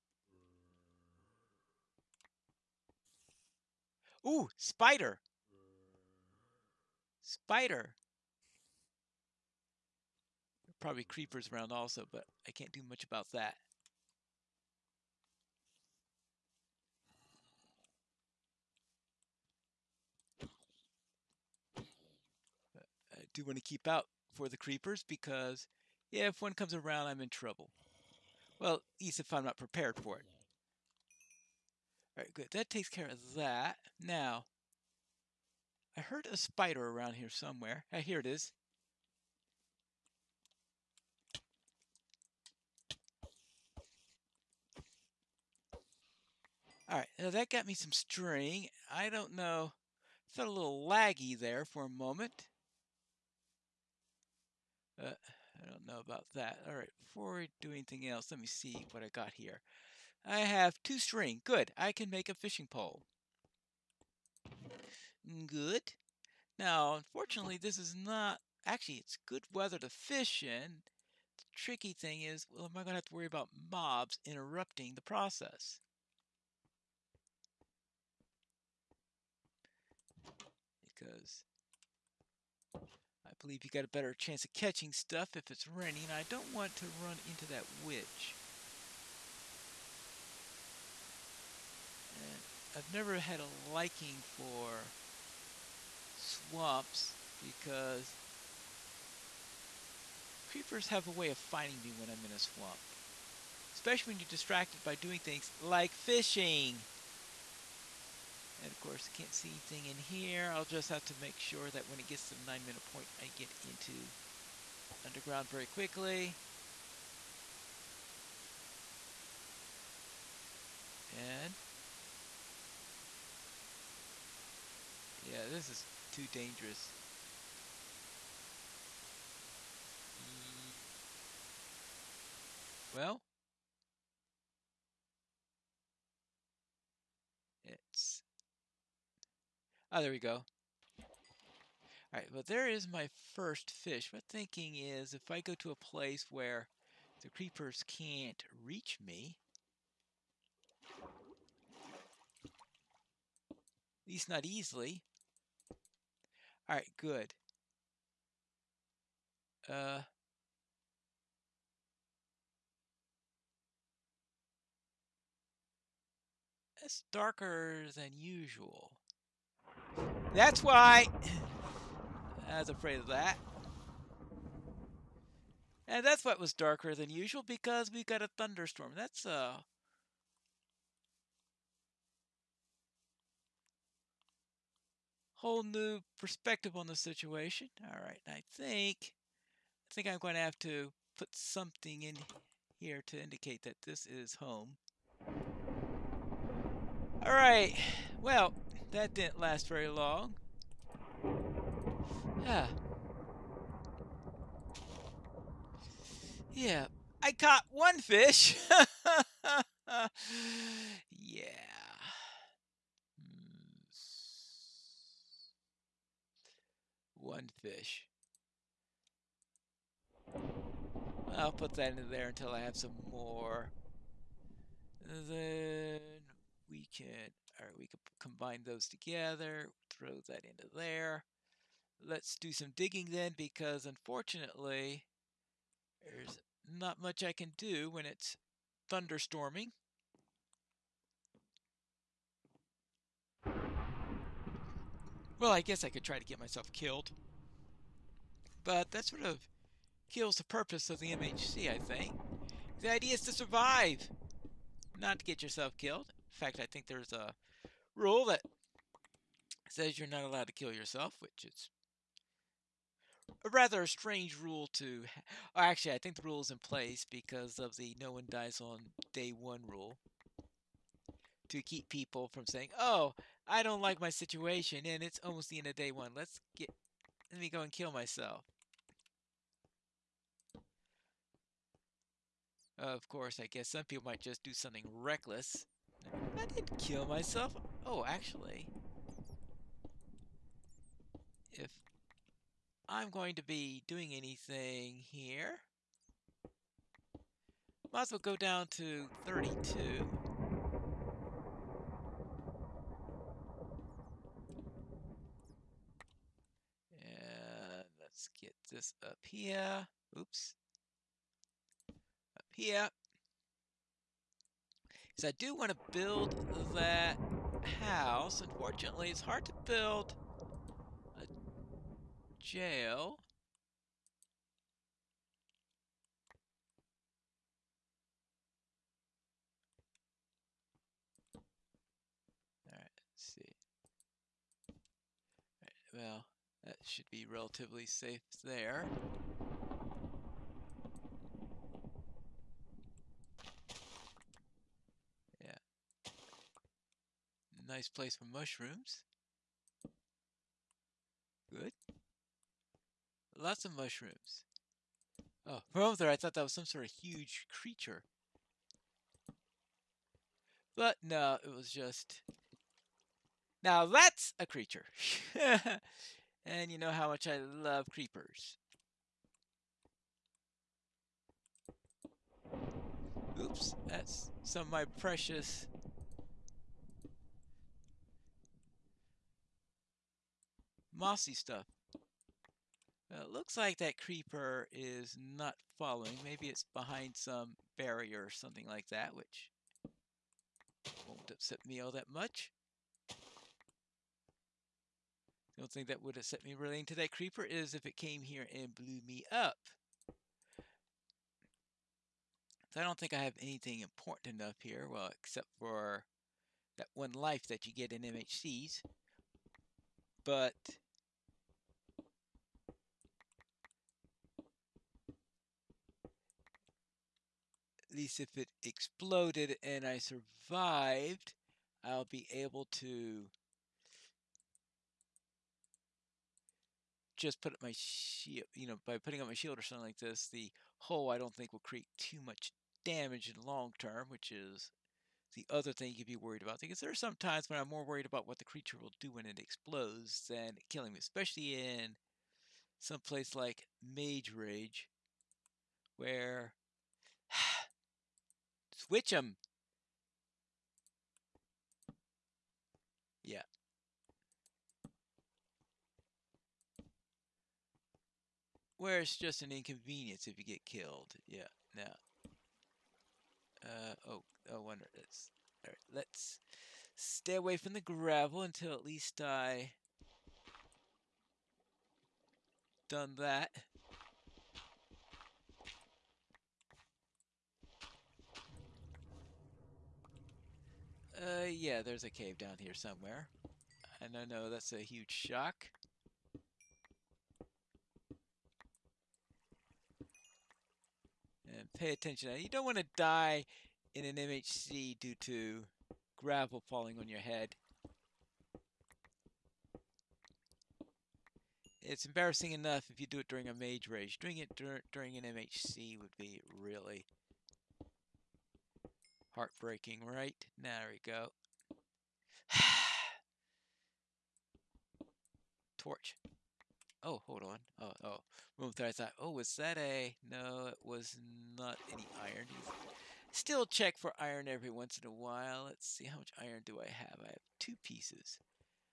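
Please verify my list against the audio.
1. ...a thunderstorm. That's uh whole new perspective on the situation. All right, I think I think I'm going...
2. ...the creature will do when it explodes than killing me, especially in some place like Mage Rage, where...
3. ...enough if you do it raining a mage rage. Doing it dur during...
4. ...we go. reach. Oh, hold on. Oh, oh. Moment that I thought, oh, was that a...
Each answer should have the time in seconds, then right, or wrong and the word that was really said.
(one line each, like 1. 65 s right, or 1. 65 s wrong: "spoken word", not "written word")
1. 178 s right
2. 438 s right
3. 502 s wrong: "during", not "raining"
4. 510 s wrong: "torch", not "reach".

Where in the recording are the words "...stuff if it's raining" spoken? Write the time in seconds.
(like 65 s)
84 s.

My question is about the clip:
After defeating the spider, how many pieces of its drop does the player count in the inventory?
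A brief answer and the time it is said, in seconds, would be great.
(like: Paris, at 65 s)
2, at 60 s.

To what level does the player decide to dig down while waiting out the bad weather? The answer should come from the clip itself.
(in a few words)
32.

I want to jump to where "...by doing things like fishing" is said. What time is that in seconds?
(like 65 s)
104 s.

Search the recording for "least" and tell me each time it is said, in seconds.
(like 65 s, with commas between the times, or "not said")
29 s, 154 s, 417 s, 468 s.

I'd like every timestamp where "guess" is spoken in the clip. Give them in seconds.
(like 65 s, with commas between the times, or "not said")
245 s, 283 s.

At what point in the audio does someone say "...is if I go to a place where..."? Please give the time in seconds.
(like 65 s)
144 s.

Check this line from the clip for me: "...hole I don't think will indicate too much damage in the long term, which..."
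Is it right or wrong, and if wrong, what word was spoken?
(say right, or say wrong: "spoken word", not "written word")
wrong: "create", not "indicate".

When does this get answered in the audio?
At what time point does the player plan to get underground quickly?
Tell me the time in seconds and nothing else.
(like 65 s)
112 s.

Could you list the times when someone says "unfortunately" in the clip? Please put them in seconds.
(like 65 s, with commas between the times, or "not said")
66 s, 233 s, 318 s.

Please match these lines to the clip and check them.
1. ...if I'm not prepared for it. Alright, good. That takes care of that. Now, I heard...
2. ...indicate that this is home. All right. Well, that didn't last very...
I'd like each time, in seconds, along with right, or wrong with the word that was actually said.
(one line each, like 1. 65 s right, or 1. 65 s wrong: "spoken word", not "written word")
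1. 29 s right
2. 193 s right.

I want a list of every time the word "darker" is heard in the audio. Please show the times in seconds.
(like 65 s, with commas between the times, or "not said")
167 s, 176 s.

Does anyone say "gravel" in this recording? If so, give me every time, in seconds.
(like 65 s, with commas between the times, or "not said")
467 s, 496 s.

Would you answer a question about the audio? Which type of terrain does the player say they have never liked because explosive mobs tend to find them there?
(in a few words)
Swamps.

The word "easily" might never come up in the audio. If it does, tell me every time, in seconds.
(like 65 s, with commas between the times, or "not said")
154 s.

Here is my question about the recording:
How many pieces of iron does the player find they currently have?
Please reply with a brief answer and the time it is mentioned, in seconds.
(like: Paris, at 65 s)
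2, at 527 s.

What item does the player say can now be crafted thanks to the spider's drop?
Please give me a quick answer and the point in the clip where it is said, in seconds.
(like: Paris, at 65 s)
Fishing pole, at 62 s.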